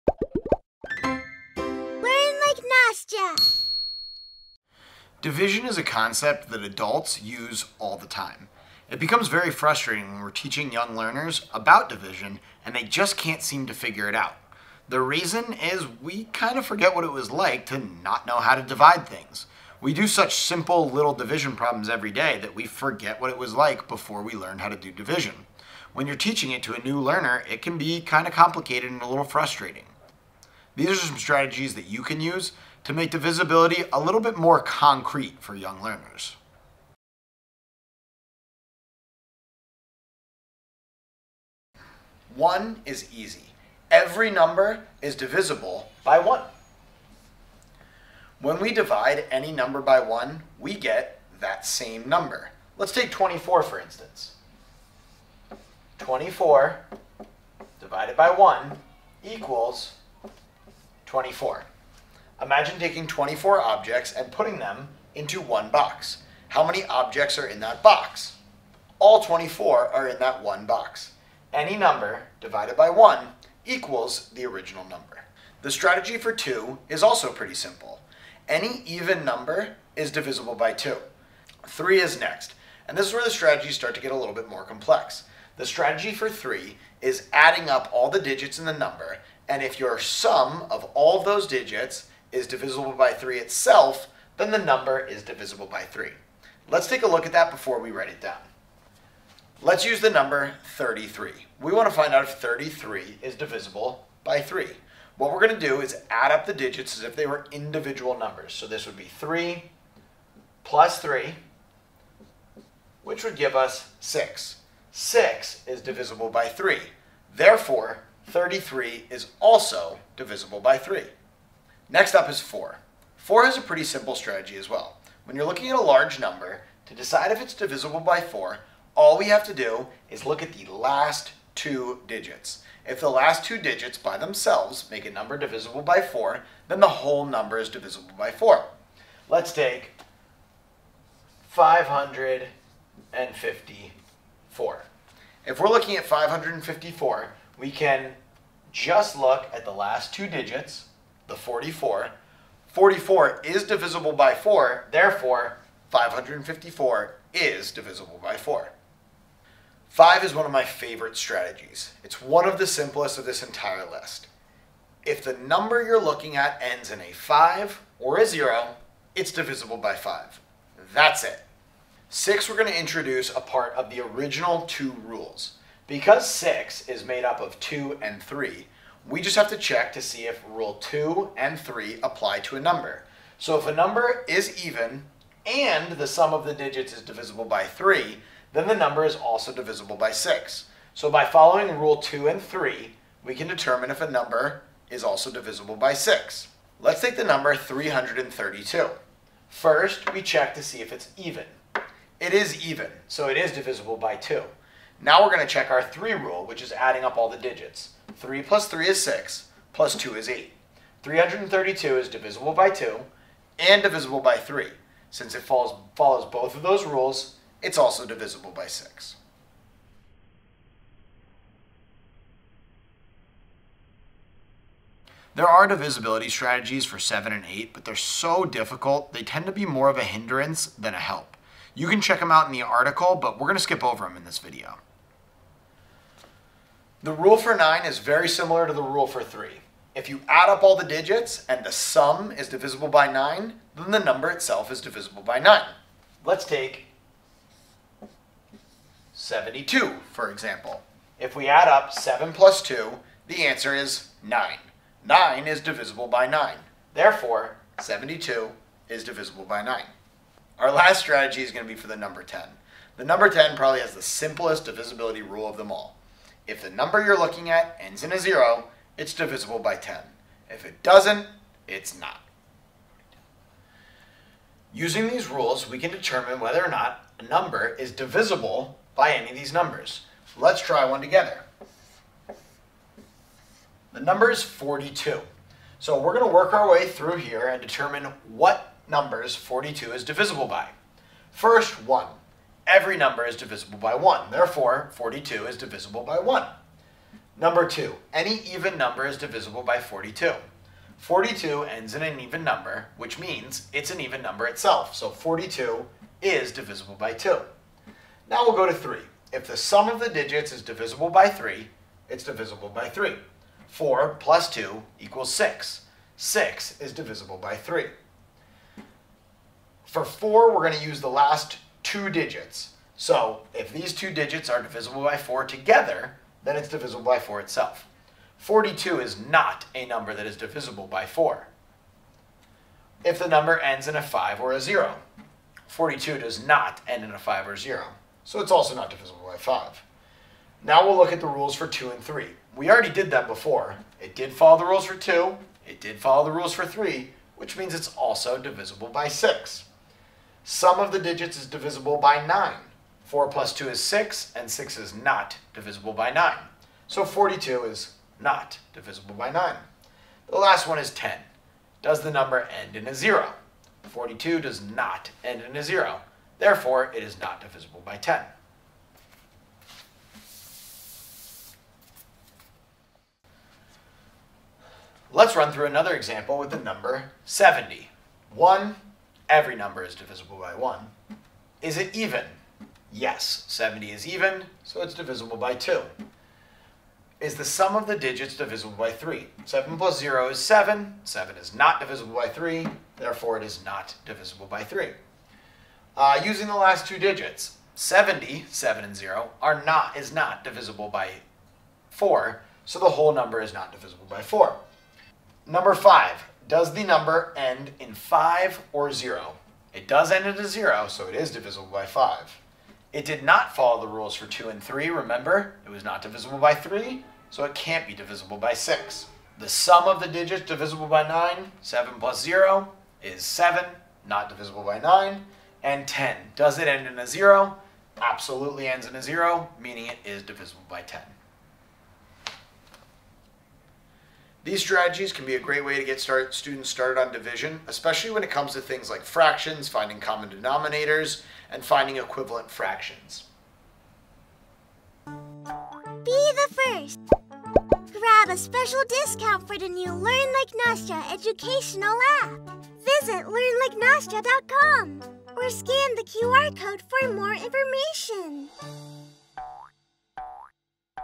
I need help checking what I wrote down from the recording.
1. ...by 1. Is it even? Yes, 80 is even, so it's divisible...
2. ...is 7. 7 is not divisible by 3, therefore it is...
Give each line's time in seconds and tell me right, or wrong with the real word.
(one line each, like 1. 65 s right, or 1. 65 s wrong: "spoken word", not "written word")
1. 380 s wrong: "70", not "80"
2. 390 s right.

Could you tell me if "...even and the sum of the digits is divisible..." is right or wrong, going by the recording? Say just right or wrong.
right.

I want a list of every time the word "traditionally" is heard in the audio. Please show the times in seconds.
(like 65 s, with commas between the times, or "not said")
not said.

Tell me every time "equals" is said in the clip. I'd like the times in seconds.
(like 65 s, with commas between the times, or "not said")
59 s, 73 s, 314 s.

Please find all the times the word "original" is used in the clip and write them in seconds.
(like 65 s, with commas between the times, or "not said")
74 s, 174 s.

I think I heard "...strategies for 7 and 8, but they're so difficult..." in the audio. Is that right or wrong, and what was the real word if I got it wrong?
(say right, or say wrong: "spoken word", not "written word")
right.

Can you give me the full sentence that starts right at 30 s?
These are some strategies that you can use to make divisibility a little bit more concrete for young learners.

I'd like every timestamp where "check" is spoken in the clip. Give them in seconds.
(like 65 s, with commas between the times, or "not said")
179 s, 200 s, 205 s, 232 s.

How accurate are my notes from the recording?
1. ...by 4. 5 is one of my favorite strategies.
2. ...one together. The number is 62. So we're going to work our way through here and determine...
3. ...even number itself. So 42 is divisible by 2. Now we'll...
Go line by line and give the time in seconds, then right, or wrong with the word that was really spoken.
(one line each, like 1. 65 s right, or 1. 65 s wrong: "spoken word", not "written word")
1. 158 s right
2. 280 s wrong: "42", not "62"
3. 303 s right.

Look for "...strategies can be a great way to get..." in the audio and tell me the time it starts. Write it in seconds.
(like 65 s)
434 s.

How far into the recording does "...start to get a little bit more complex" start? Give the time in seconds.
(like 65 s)
83 s.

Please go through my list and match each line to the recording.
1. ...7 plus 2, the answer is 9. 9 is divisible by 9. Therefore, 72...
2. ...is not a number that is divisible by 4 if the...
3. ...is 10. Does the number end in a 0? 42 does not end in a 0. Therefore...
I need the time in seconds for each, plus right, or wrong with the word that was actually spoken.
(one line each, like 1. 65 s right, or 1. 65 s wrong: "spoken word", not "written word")
1. 251 s right
2. 329 s right
3. 360 s right.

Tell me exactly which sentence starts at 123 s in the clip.
4 has a pretty simple strategy as well.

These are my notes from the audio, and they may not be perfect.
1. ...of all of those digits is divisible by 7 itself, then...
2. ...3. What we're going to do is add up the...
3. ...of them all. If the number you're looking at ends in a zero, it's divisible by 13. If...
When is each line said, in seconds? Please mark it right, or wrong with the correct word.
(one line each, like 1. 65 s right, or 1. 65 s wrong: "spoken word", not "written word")
1. 90 s wrong: "3", not "7"
2. 104 s right
3. 265 s wrong: "10", not "13".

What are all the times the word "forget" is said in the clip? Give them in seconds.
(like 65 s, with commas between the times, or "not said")
16 s, 22 s.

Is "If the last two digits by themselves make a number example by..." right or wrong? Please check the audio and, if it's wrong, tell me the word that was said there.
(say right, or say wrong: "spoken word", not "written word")
wrong: "divisible", not "example".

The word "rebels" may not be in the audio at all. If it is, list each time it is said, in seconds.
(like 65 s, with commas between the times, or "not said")
not said.